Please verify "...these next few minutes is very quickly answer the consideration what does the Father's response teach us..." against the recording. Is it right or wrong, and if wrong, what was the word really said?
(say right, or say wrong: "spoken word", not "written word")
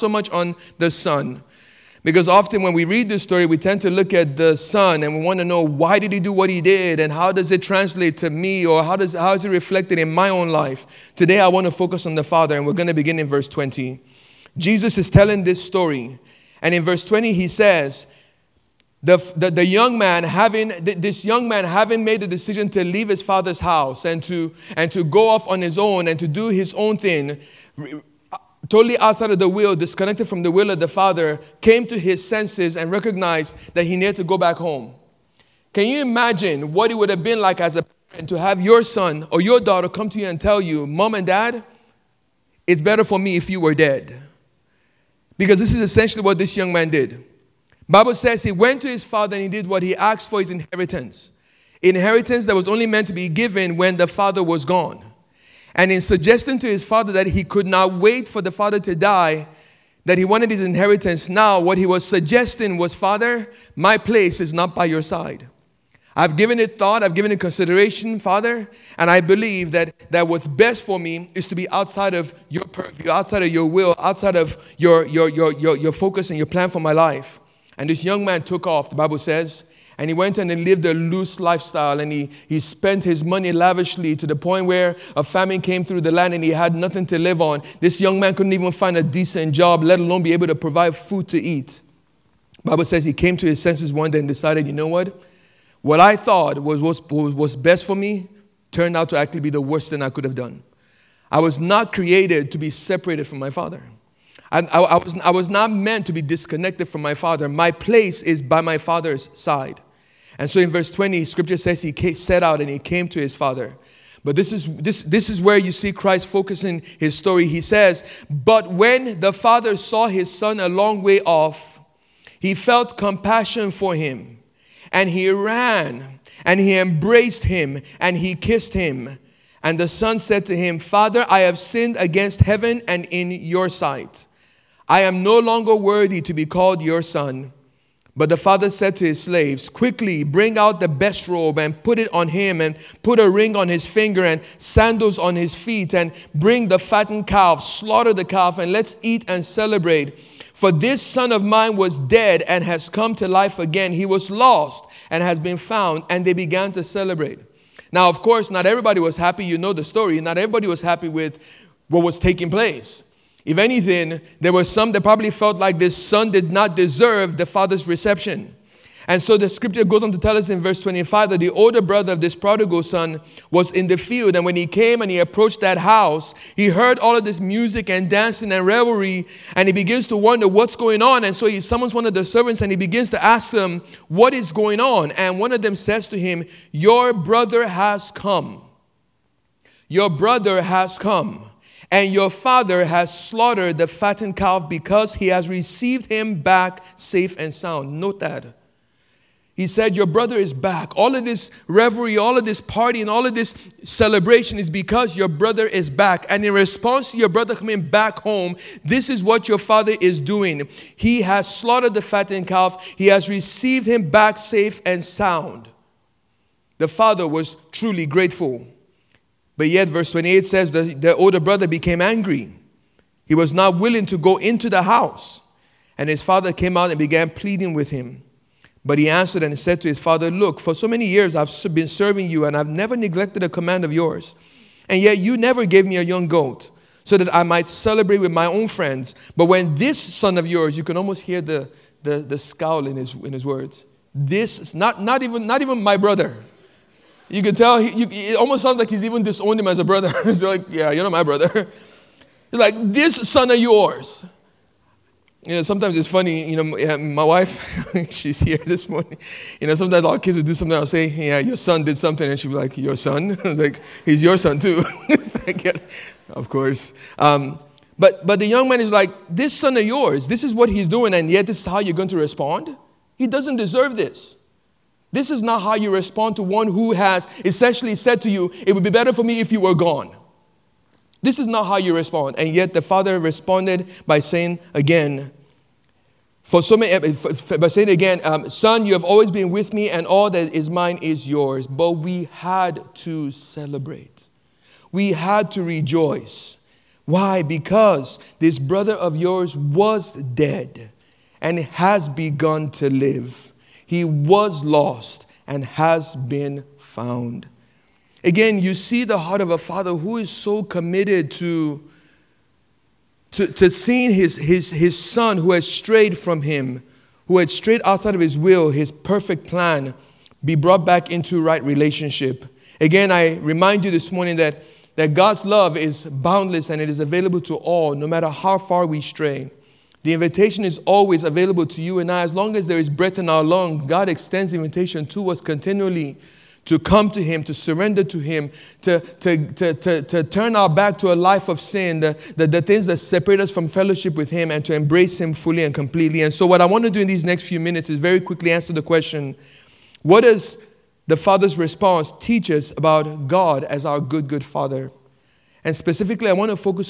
wrong: "question", not "consideration".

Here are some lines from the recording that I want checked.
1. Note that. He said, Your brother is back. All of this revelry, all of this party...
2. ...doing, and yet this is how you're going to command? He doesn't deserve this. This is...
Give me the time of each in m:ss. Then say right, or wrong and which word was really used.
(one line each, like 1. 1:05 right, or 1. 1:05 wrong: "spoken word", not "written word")
1. 3:17 right
2. 4:30 wrong: "respond", not "command".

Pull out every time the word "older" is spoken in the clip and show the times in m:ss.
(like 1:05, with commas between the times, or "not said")
2:51, 3:41.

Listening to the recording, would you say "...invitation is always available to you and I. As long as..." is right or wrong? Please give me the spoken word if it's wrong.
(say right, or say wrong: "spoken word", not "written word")
right.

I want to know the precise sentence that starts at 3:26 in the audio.
And in response to your brother coming back home, this is what your father is doing.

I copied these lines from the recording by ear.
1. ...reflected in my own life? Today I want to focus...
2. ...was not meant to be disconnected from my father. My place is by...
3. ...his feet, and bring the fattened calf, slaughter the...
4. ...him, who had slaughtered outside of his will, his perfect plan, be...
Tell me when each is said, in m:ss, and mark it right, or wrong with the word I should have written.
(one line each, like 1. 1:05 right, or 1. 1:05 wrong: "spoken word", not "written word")
1. 0:09 right
2. 1:45 right
3. 2:25 right
4. 5:16 wrong: "strayed", not "slaughtered".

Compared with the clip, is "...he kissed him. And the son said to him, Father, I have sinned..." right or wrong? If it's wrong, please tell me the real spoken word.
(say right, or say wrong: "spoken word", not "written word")
right.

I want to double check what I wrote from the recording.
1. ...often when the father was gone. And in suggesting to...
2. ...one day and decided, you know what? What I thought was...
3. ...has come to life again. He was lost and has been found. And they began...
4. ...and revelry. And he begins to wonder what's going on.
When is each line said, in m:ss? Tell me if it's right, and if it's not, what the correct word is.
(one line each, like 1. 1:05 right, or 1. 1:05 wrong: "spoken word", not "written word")
1. 0:53 wrong: "given", not "often"
2. 1:33 right
3. 2:32 right
4. 2:58 right.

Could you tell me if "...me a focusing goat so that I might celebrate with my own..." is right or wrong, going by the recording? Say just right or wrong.
wrong.